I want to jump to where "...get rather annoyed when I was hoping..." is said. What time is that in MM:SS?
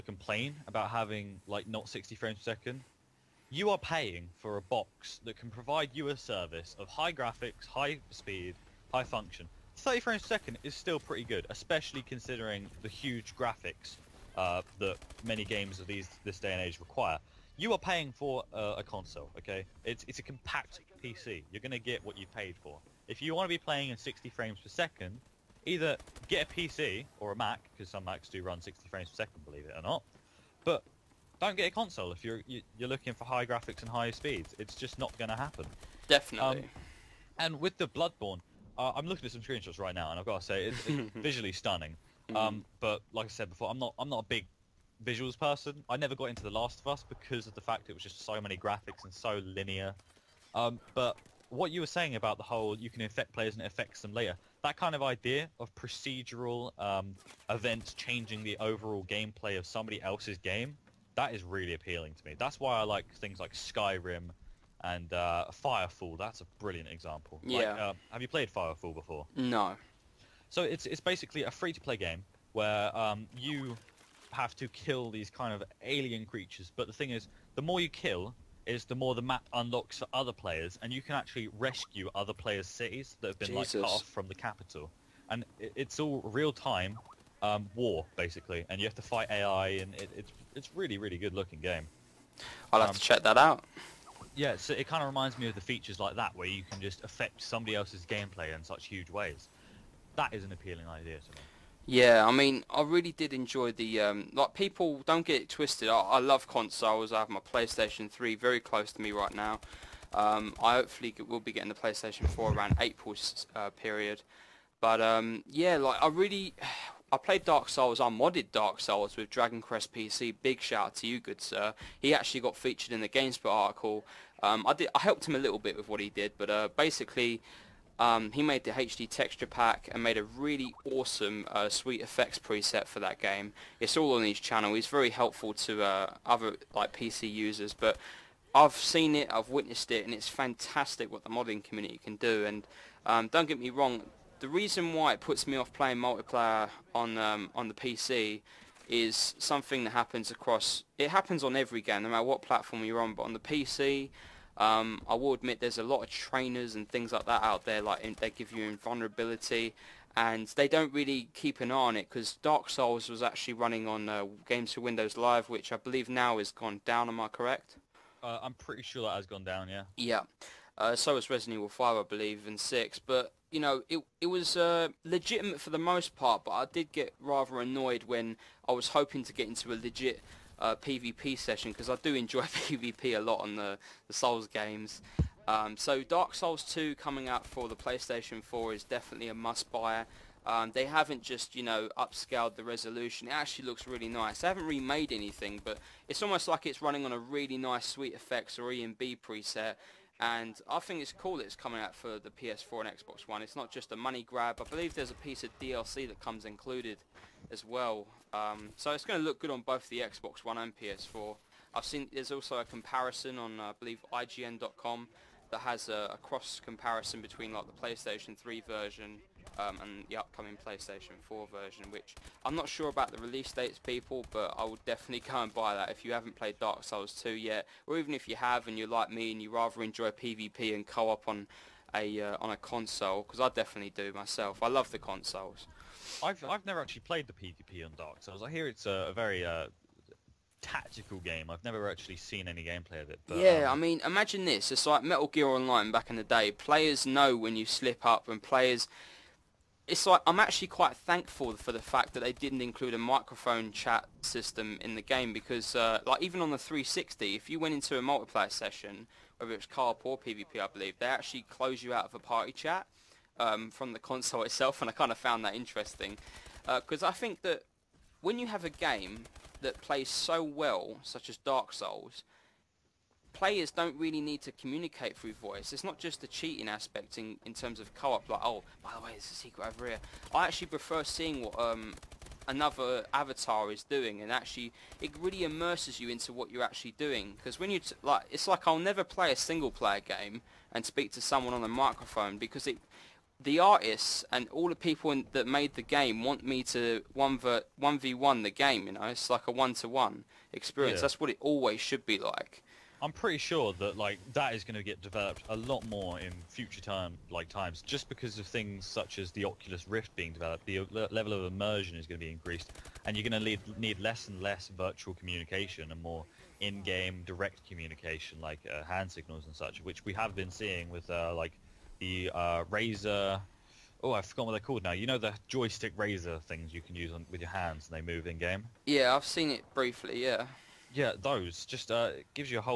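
02:56.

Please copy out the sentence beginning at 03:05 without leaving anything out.
Um, so Dark Souls 2 coming out for the PlayStation 4 is definitely a must-buy.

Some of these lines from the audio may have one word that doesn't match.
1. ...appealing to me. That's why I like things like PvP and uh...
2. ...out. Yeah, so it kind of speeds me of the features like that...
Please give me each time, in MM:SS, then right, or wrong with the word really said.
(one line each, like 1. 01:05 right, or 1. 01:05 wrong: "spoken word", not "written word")
1. 01:01 wrong: "Skyrim", not "PvP"
2. 01:33 wrong: "reminds", not "speeds".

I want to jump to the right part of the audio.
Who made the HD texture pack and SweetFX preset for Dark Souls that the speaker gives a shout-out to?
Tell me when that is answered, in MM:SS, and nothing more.
01:59.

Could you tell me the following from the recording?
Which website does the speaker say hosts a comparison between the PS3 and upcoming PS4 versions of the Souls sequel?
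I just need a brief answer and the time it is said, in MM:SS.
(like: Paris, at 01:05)
IGN.com, at 03:34.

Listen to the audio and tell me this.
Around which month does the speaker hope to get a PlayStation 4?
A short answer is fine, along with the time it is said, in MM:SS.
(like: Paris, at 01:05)
April, at 01:52.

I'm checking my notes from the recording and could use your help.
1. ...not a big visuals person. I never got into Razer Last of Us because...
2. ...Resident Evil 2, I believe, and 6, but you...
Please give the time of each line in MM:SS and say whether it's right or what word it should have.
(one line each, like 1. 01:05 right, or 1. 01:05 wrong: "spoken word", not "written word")
1. 00:44 wrong: "The", not "Razer"
2. 02:51 wrong: "5", not "2".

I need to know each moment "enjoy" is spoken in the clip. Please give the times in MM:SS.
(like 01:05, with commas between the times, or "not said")
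01:43, 03:02, 03:49.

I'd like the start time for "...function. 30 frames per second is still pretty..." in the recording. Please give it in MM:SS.
00:09.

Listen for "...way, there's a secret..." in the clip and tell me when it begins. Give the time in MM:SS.
04:39.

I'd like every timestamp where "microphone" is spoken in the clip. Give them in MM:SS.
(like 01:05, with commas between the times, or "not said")
04:12, 04:51.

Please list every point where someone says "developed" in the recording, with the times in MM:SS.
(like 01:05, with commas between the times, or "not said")
05:05, 05:10.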